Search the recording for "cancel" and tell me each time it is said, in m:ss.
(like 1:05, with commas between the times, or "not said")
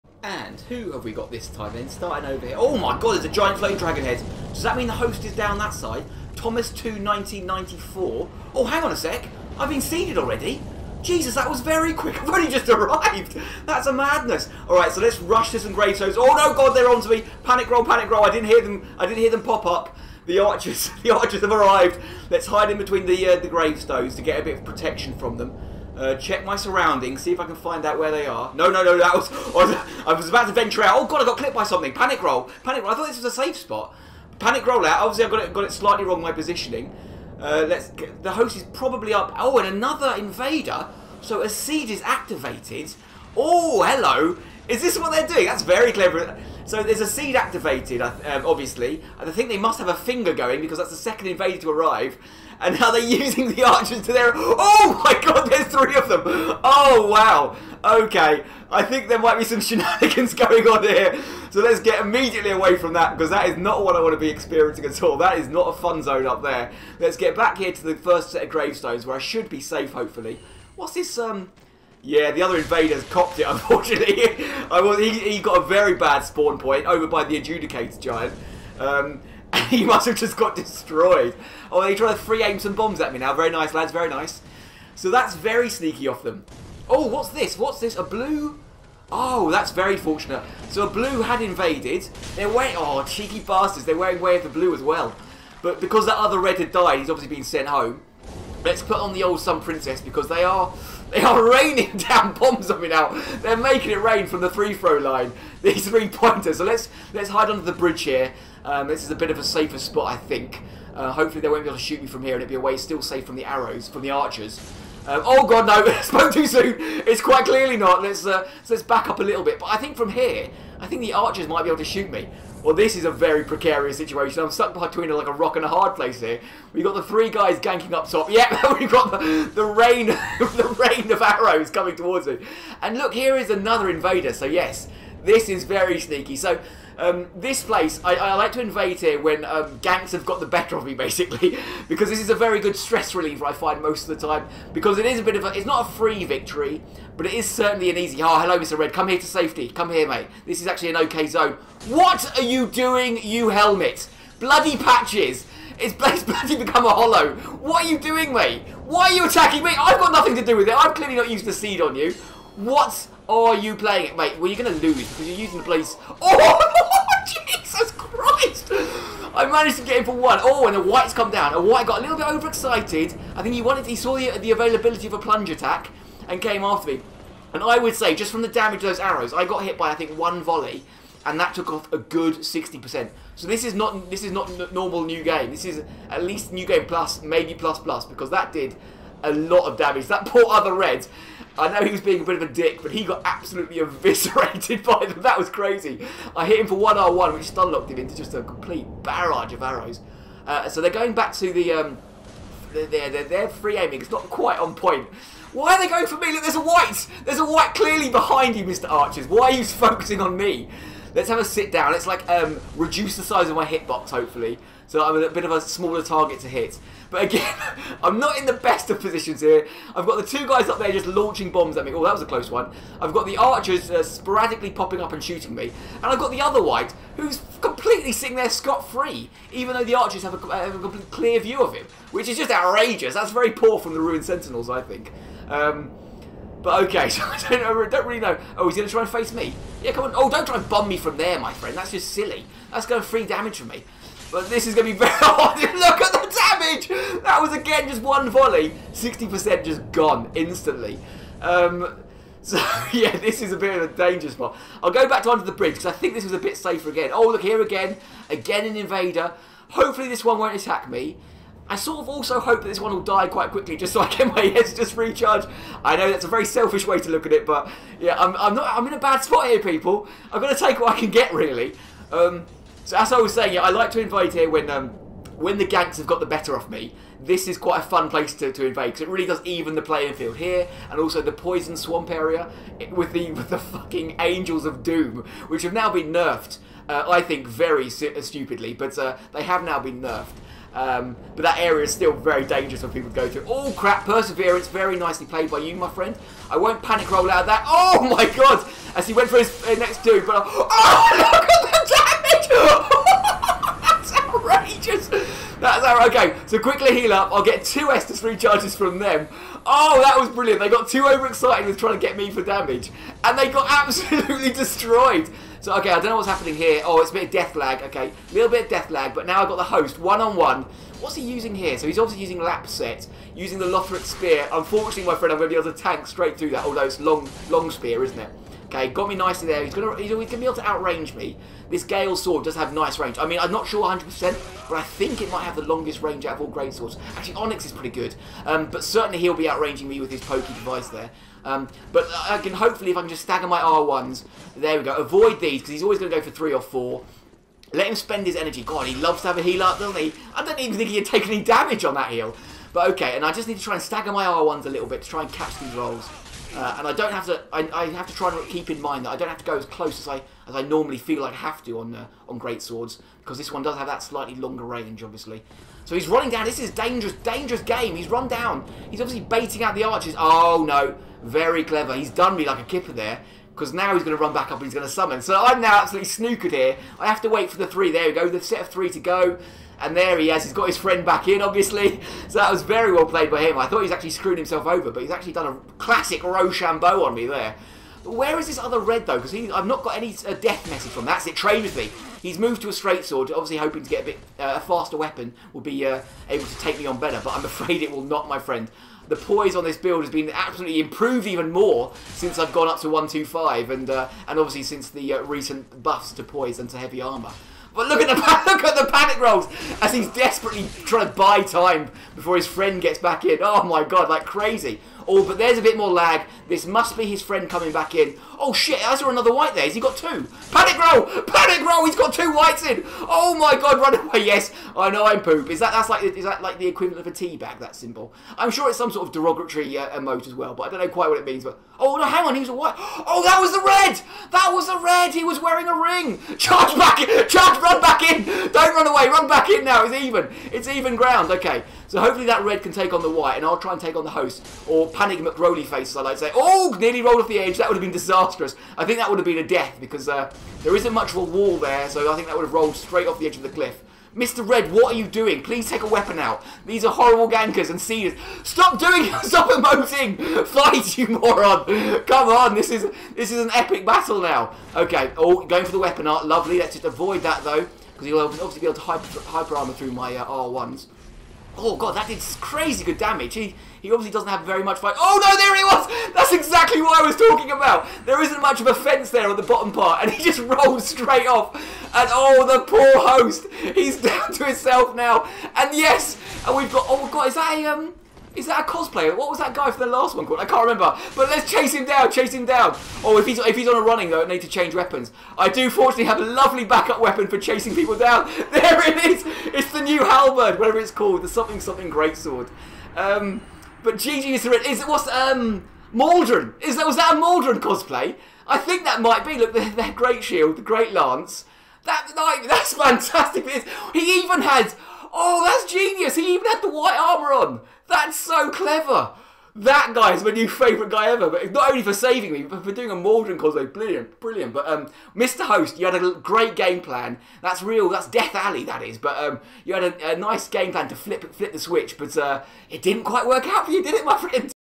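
not said.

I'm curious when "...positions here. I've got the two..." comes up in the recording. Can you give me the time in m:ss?
3:39.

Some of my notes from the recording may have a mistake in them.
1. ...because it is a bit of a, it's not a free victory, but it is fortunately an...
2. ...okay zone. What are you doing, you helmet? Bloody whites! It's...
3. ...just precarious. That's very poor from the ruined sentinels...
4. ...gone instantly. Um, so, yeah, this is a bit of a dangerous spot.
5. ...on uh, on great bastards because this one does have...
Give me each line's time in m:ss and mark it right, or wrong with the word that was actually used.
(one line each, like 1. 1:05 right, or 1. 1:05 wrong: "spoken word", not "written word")
1. 2:24 wrong: "certainly", not "fortunately"
2. 2:30 wrong: "patches", not "whites"
3. 3:52 wrong: "outrageous", not "precarious"
4. 4:09 right
5. 6:01 wrong: "swords", not "bastards".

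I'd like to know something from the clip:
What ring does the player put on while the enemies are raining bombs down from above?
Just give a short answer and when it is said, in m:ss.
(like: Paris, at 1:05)
Sun Princess, at 1:39.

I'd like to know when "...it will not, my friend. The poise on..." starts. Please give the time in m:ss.
6:37.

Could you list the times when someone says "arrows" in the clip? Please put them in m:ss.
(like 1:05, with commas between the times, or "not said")
1:53, 2:11, 2:58, 3:19.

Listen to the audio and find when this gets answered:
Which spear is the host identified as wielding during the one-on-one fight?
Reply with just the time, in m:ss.
5:23.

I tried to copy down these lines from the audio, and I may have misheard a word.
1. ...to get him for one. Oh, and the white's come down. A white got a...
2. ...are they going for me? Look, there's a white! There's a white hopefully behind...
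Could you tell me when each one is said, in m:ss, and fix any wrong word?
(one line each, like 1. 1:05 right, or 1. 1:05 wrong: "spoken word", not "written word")
1. 2:49 right
2. 3:25 wrong: "clearly", not "hopefully".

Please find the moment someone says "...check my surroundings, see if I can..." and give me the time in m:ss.
0:26.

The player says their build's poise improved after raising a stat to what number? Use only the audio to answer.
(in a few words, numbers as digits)
125.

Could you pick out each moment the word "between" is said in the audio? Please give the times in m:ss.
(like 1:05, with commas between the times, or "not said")
0:22, 2:04.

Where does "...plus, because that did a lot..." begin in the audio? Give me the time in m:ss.
3:07.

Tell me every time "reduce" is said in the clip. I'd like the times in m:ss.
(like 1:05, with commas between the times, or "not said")
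3:32.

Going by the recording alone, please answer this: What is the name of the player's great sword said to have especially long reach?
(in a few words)
Gale Sword.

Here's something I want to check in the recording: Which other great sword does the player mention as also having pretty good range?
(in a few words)
Onyx.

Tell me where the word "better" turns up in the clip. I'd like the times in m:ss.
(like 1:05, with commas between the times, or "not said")
2:20, 4:36, 6:36.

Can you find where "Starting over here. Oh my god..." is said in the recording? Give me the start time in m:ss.
0:01.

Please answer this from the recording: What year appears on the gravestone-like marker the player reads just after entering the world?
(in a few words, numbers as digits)
1994.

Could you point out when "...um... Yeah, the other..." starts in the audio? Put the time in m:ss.
1:11.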